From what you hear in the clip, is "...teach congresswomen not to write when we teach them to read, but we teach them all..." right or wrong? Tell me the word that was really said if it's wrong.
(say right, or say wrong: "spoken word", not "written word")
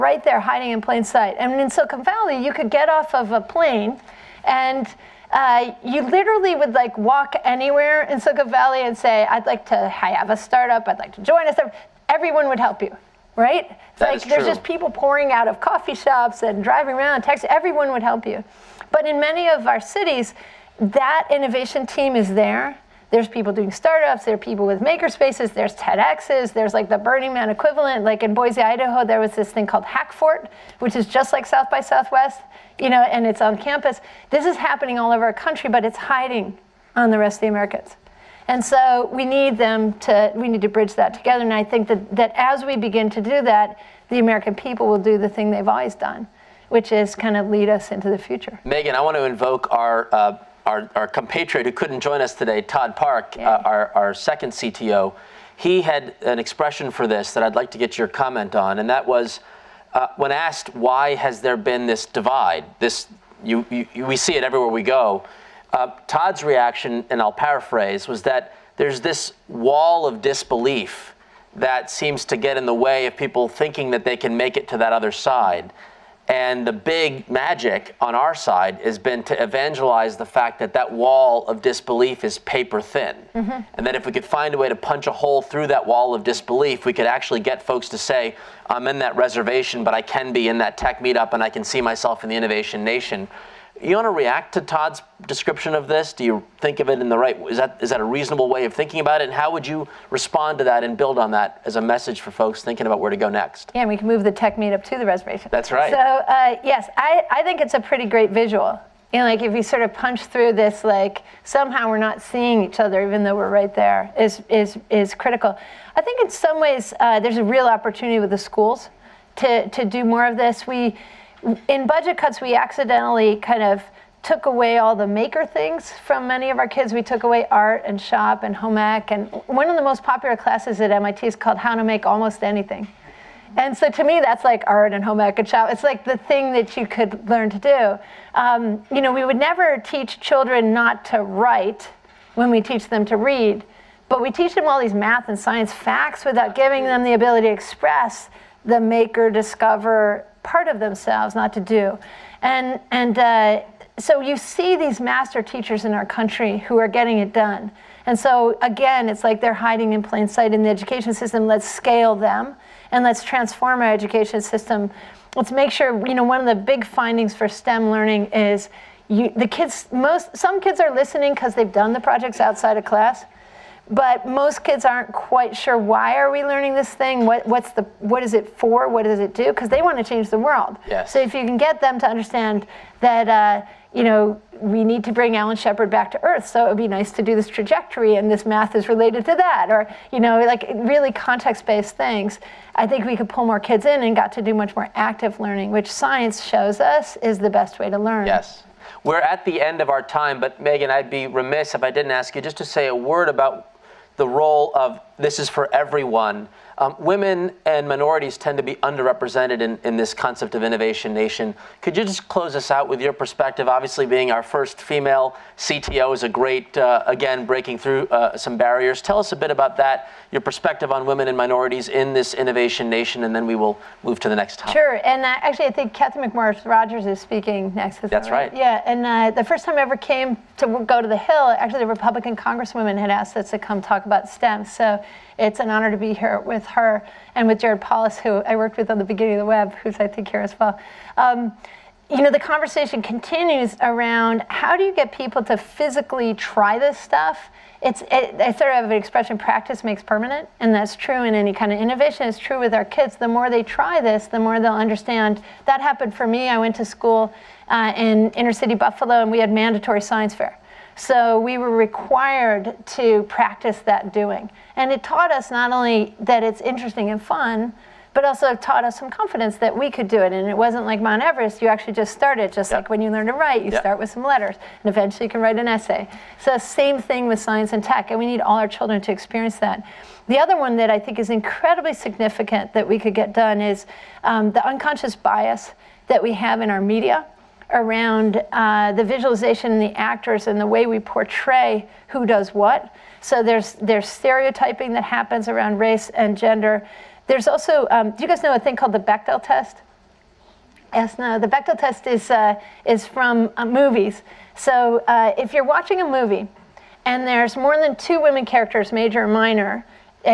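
wrong: "children", not "congresswomen".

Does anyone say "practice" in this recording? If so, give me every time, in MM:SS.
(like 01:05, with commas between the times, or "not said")
04:09, 04:23.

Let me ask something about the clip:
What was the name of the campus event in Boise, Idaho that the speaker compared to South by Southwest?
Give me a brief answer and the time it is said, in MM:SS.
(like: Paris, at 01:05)
Hackfort, at 00:29.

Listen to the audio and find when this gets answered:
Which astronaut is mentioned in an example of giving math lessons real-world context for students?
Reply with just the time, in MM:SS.
03:05.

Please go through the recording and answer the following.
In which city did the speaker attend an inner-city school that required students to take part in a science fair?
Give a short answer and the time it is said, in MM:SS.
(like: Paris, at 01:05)
Buffalo, at 04:18.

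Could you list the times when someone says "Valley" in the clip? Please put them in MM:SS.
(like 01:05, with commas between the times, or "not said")
00:02, 00:08.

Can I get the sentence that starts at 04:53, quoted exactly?
So there's there's stereotyping that happens around race and gender.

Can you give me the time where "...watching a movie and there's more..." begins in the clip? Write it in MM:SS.
05:05.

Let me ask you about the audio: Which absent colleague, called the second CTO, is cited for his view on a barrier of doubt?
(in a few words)
Todd Park.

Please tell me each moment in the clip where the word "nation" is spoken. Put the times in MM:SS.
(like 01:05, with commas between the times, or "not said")
01:32, 03:31, 03:42.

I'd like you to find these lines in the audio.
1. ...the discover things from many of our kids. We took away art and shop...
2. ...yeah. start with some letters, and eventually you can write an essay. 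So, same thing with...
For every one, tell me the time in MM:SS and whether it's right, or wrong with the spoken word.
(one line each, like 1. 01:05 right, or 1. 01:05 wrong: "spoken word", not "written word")
1. 02:04 wrong: "maker", not "discover"
2. 04:33 right.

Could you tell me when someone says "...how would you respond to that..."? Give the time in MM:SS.
01:39.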